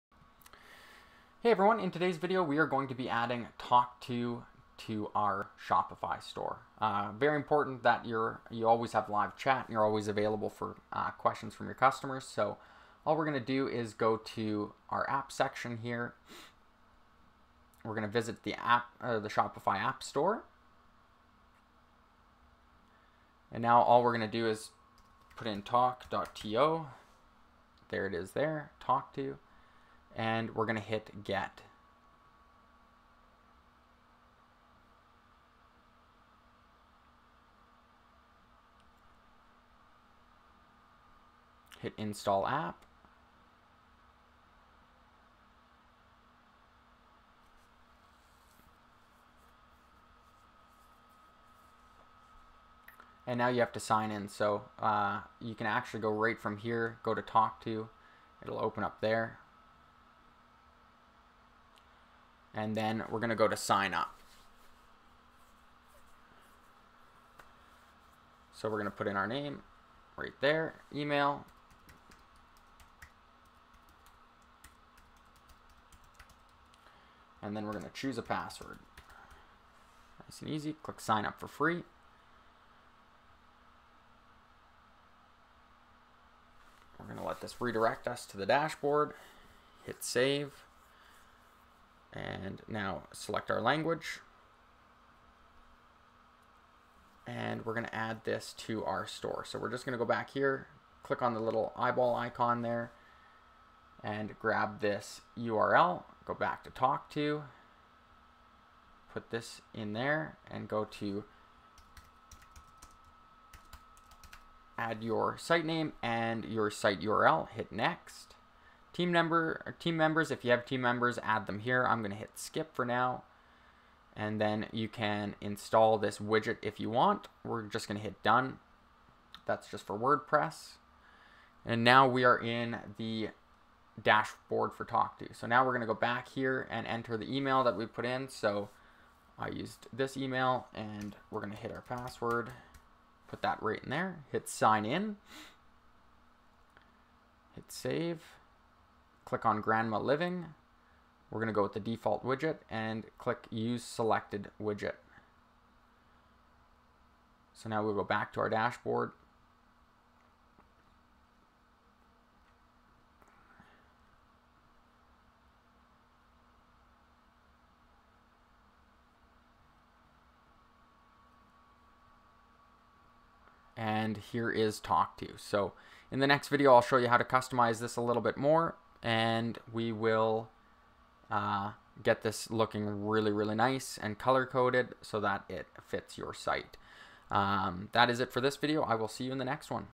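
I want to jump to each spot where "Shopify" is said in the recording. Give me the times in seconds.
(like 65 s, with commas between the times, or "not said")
5 s, 19 s.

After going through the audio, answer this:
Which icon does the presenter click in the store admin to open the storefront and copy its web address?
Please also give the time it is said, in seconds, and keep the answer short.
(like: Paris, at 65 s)
eyeball icon, at 101 s.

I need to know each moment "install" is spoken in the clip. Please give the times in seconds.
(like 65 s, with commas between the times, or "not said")
41 s, 125 s.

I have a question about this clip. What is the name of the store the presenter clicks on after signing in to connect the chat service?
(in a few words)
Grandma Living.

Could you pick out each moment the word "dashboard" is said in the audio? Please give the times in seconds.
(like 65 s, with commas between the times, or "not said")
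88 s, 134 s, 158 s.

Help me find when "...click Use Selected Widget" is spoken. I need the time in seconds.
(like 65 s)
153 s.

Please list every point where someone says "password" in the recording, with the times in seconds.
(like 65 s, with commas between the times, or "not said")
78 s, 141 s.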